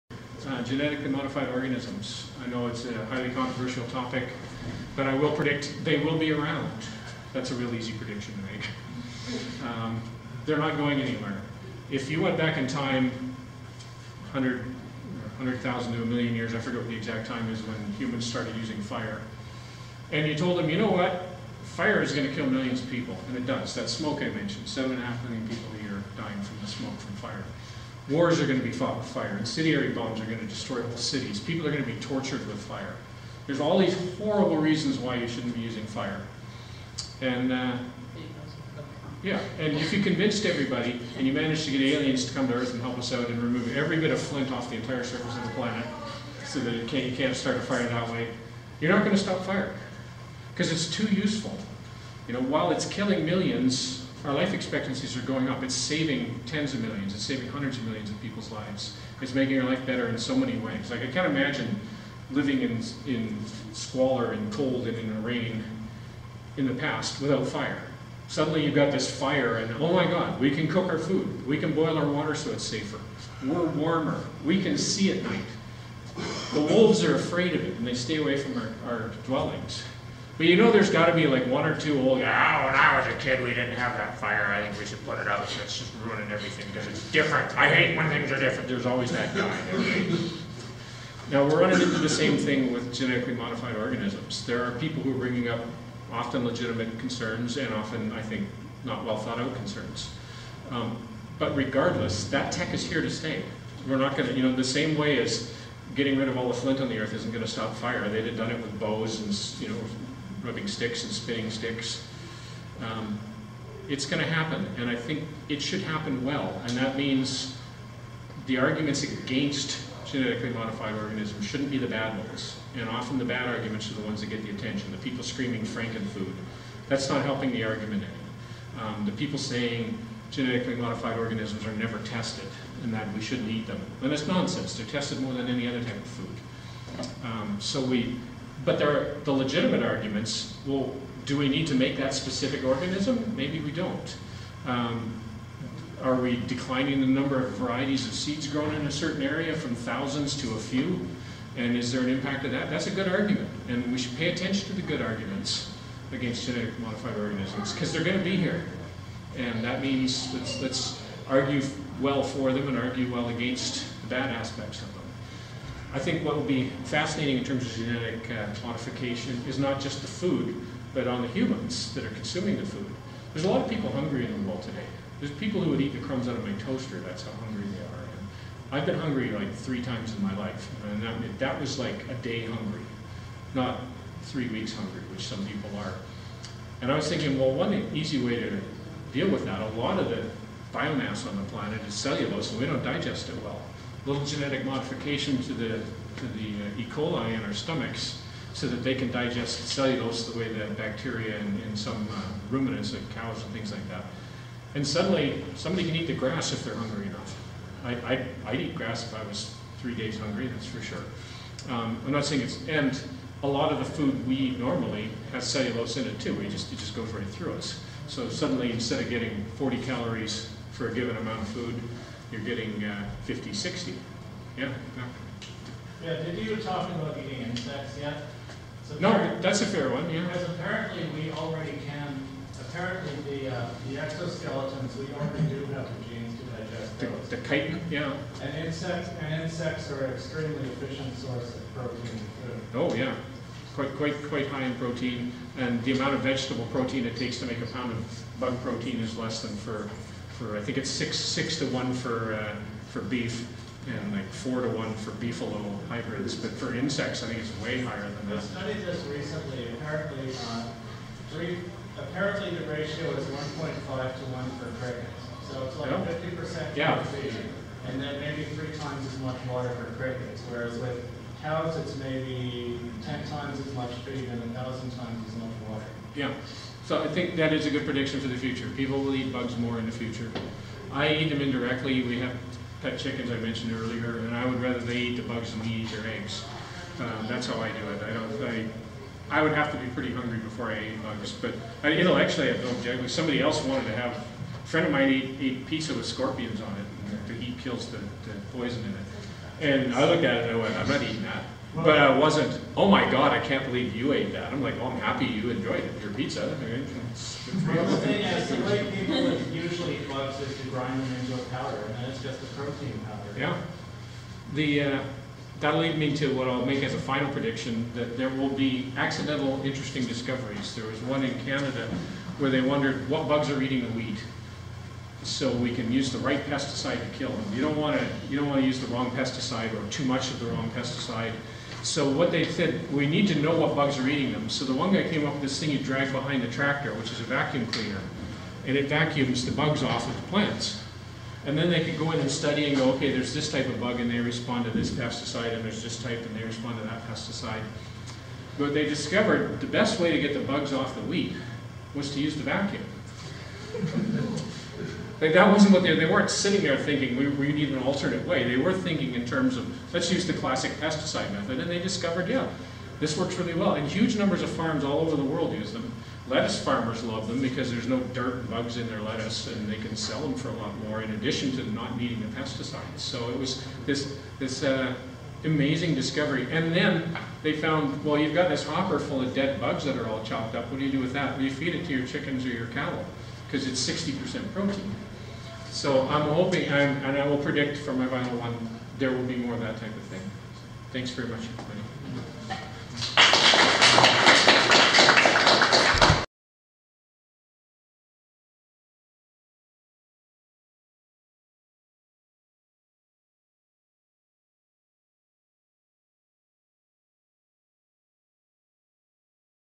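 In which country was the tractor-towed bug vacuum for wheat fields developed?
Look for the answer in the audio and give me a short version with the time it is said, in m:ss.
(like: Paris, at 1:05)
Canada, at 5:21.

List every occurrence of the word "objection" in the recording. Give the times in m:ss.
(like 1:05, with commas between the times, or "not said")
4:52.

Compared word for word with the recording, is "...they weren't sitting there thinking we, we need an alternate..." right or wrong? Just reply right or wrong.
right.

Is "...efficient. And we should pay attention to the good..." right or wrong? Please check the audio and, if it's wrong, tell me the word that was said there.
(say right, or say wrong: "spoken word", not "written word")
wrong: "argument", not "efficient".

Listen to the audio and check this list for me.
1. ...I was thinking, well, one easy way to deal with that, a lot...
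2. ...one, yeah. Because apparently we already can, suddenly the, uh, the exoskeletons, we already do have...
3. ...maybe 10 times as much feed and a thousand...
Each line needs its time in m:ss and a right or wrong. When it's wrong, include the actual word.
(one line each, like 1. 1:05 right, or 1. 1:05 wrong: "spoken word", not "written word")
1. 3:06 right
2. 3:49 wrong: "apparently", not "suddenly"
3. 4:31 right.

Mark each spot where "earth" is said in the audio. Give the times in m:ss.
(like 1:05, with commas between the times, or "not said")
0:42, 1:46.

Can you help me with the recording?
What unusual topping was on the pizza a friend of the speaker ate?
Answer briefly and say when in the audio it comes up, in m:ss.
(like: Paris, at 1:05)
scorpions, at 4:56.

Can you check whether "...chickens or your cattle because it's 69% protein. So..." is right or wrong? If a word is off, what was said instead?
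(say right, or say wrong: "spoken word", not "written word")
wrong: "60", not "69".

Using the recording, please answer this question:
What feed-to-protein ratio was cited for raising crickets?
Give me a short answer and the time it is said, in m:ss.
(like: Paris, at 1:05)
1.5 to 1, at 4:23.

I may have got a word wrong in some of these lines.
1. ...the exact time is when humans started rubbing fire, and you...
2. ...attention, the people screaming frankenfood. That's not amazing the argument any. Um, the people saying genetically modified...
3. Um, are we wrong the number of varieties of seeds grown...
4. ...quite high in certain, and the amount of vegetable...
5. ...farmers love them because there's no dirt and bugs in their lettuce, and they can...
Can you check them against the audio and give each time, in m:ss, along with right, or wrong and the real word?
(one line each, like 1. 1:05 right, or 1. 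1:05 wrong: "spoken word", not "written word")
1. 0:16 wrong: "using", not "rubbing"
2. 2:04 wrong: "helping", not "amazing"
3. 2:24 wrong: "declining", not "wrong"
4. 4:04 wrong: "protein", not "certain"
5. 6:06 right.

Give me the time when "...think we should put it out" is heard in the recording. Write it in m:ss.
1:24.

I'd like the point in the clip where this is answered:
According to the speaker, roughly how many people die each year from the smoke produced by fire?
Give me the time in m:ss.
0:24.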